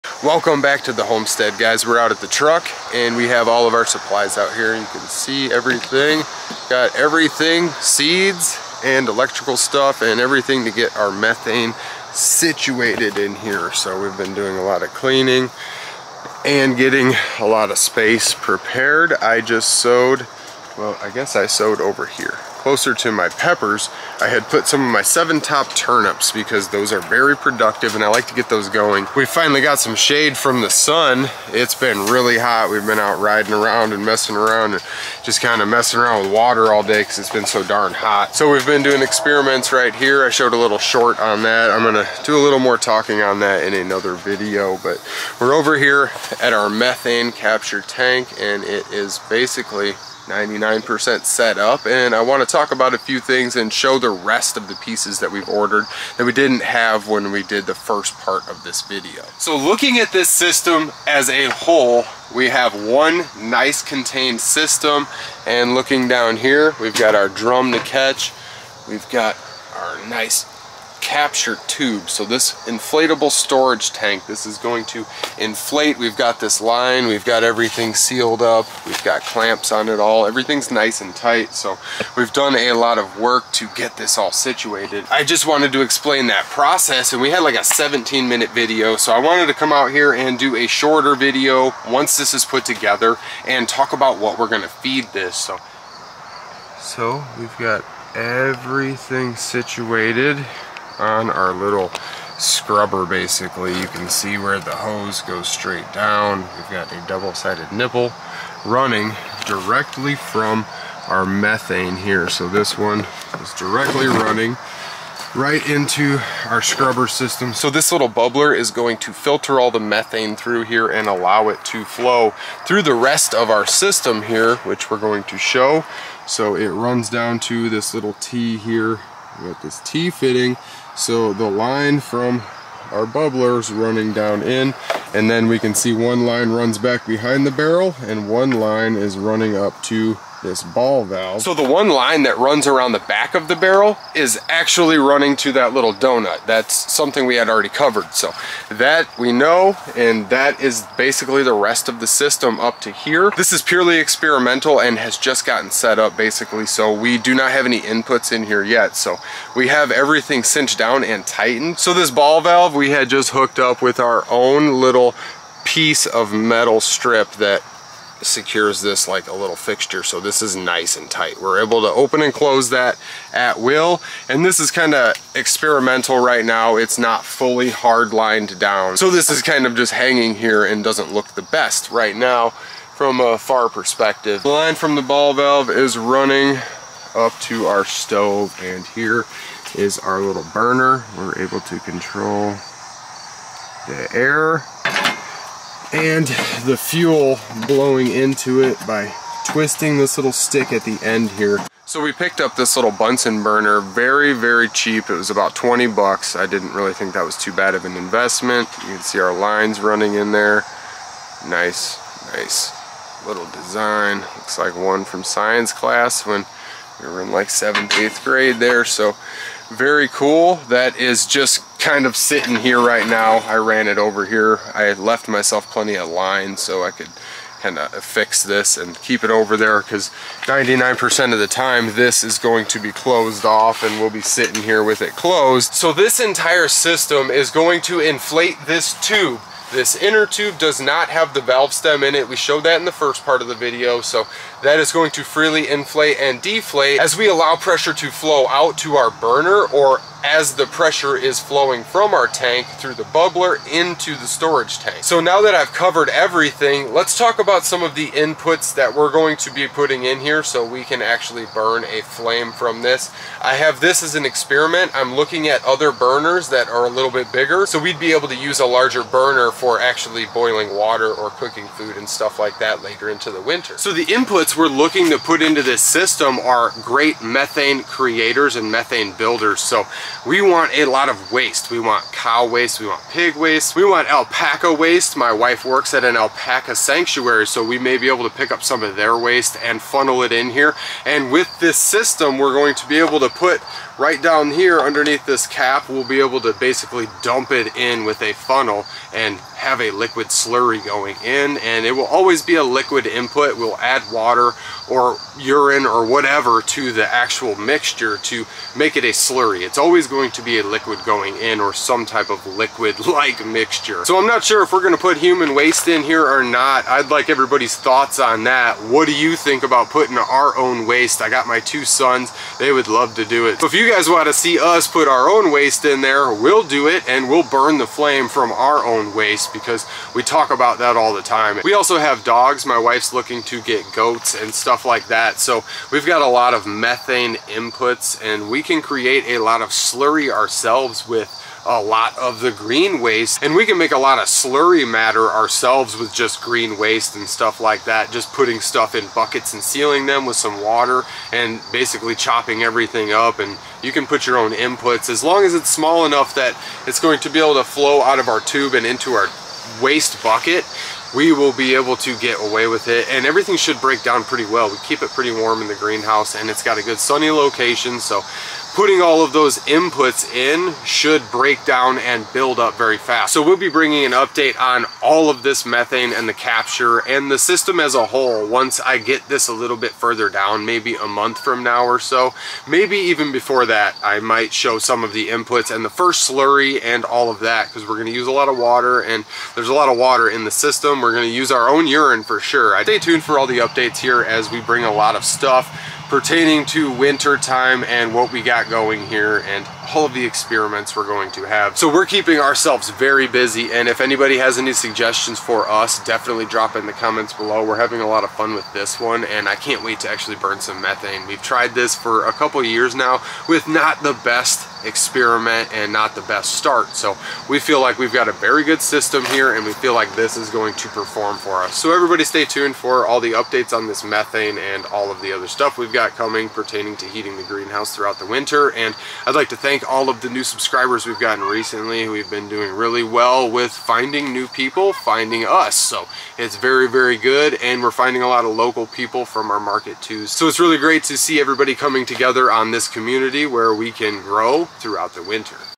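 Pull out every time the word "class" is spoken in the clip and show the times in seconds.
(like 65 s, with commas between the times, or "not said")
215 s.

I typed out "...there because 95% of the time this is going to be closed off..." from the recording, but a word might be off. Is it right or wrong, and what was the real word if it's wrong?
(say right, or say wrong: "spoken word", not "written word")
wrong: "99", not "95".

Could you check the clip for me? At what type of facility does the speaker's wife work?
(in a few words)
Alpaca sanctuary.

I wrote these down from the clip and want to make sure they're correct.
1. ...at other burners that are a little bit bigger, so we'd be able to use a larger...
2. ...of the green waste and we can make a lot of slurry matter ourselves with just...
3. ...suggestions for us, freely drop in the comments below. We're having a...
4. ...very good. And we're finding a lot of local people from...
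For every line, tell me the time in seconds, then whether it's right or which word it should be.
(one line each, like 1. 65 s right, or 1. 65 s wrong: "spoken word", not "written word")
1. 265 s right
2. 342 s right
3. 404 s wrong: "definitely", not "freely"
4. 436 s right.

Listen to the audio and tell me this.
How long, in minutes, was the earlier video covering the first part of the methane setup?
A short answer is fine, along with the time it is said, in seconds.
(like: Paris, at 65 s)
17, at 87 s.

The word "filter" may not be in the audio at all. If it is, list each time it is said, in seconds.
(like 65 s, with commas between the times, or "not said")
119 s.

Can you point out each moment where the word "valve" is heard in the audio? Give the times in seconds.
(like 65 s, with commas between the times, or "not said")
141 s, 162 s, 185 s, 241 s.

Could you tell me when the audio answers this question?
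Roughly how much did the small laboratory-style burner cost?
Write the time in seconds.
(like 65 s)
205 s.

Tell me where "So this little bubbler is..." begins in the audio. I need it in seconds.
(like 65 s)
117 s.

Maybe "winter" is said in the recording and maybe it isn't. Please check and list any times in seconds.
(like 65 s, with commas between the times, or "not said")
273 s, 396 s, 428 s, 445 s.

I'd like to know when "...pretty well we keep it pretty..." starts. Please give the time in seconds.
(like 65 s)
364 s.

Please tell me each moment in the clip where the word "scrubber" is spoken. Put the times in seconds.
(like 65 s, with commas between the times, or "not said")
102 s, 116 s.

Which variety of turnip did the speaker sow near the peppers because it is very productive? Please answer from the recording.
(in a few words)
Seven top.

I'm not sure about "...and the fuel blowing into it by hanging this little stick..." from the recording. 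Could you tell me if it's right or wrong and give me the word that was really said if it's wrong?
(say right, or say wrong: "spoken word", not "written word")
wrong: "twisting", not "hanging".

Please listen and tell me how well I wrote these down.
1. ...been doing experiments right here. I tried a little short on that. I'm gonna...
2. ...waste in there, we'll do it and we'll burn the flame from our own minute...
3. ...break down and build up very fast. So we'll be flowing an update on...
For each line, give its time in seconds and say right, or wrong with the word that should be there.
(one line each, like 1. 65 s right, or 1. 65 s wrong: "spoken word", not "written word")
1. 38 s wrong: "showed", not "tried"
2. 325 s wrong: "waste", not "minute"
3. 371 s wrong: "bringing", not "flowing".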